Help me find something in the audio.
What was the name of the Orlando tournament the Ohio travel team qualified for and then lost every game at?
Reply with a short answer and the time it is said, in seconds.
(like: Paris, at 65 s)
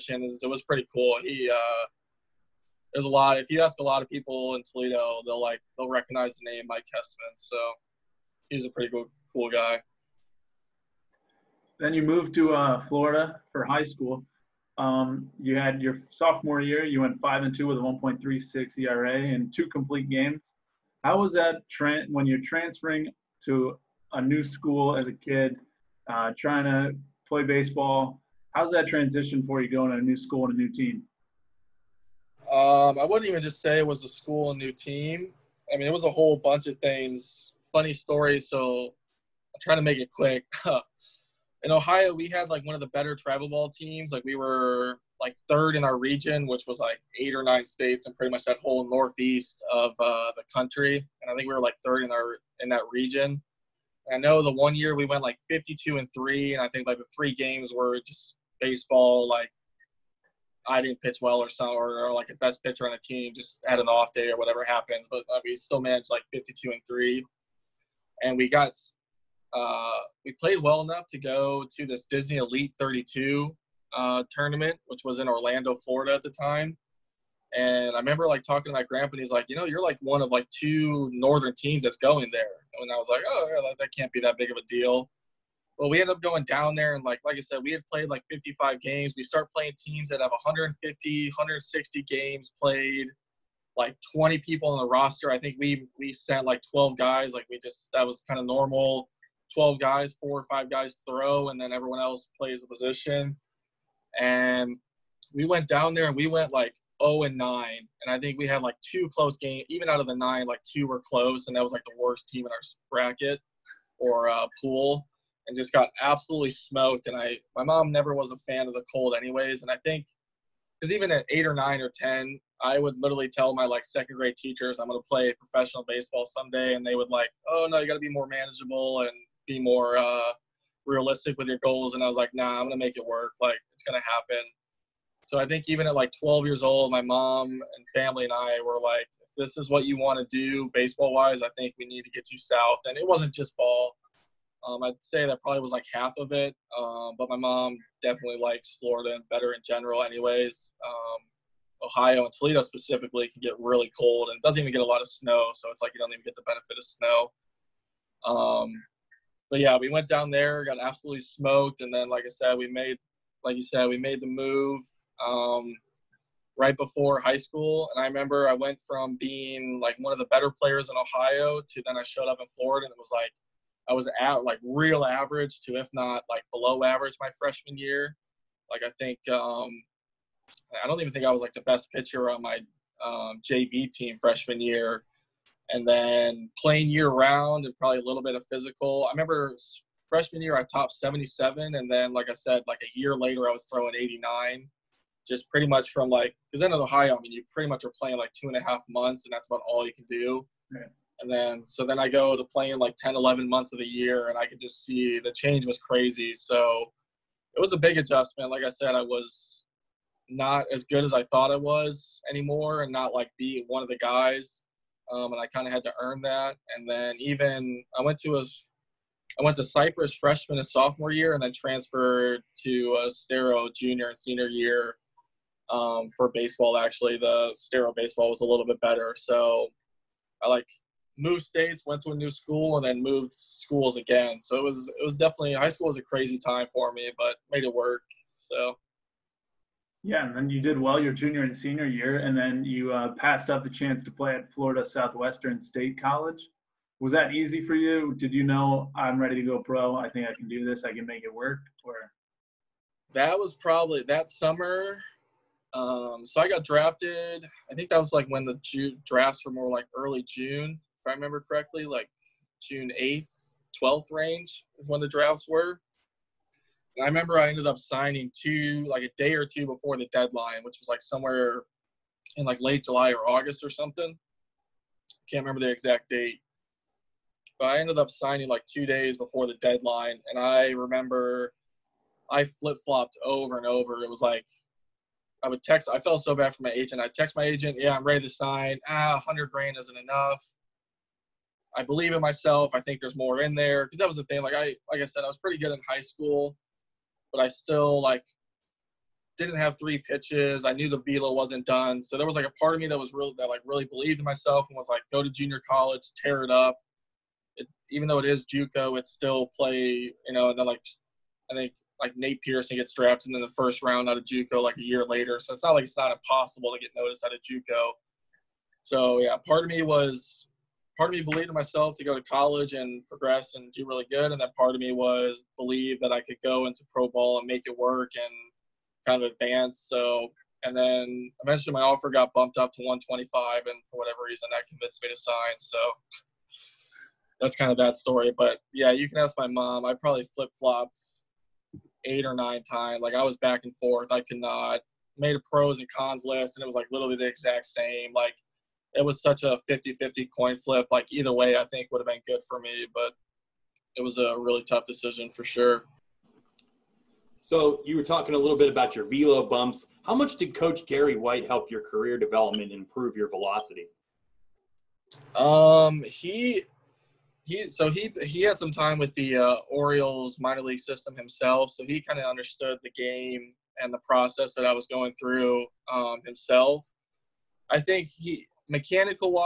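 Disney Elite 32, at 72 s.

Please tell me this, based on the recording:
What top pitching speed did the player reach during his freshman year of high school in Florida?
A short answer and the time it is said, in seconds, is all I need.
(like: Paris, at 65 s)
77, at 190 s.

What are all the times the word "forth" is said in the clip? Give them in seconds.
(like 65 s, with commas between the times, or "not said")
343 s.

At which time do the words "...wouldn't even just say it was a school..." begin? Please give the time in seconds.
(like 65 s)
33 s.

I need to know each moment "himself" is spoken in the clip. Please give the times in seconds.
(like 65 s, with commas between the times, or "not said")
371 s, 376 s.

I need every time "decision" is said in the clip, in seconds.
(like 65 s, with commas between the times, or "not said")
354 s.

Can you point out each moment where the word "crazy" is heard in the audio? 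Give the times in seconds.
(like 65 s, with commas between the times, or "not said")
205 s, 236 s.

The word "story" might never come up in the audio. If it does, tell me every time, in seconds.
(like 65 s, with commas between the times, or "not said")
37 s, 337 s.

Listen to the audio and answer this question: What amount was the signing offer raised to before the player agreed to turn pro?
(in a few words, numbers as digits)
125.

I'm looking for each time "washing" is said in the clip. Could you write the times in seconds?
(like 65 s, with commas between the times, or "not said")
not said.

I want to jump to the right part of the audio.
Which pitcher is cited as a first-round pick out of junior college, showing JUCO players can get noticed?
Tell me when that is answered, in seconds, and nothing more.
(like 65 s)
312 s.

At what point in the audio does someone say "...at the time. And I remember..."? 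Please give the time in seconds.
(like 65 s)
76 s.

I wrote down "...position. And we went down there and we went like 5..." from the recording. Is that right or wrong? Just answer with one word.
wrong.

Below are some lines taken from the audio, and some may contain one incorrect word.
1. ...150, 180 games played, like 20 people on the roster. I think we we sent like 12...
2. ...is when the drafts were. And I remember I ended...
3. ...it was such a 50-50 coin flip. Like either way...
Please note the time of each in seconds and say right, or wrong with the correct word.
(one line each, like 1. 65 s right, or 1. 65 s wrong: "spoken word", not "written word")
1. 90 s wrong: "160", not "180"
2. 264 s right
3. 348 s right.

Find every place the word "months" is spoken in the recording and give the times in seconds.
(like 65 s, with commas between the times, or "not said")
198 s, 203 s.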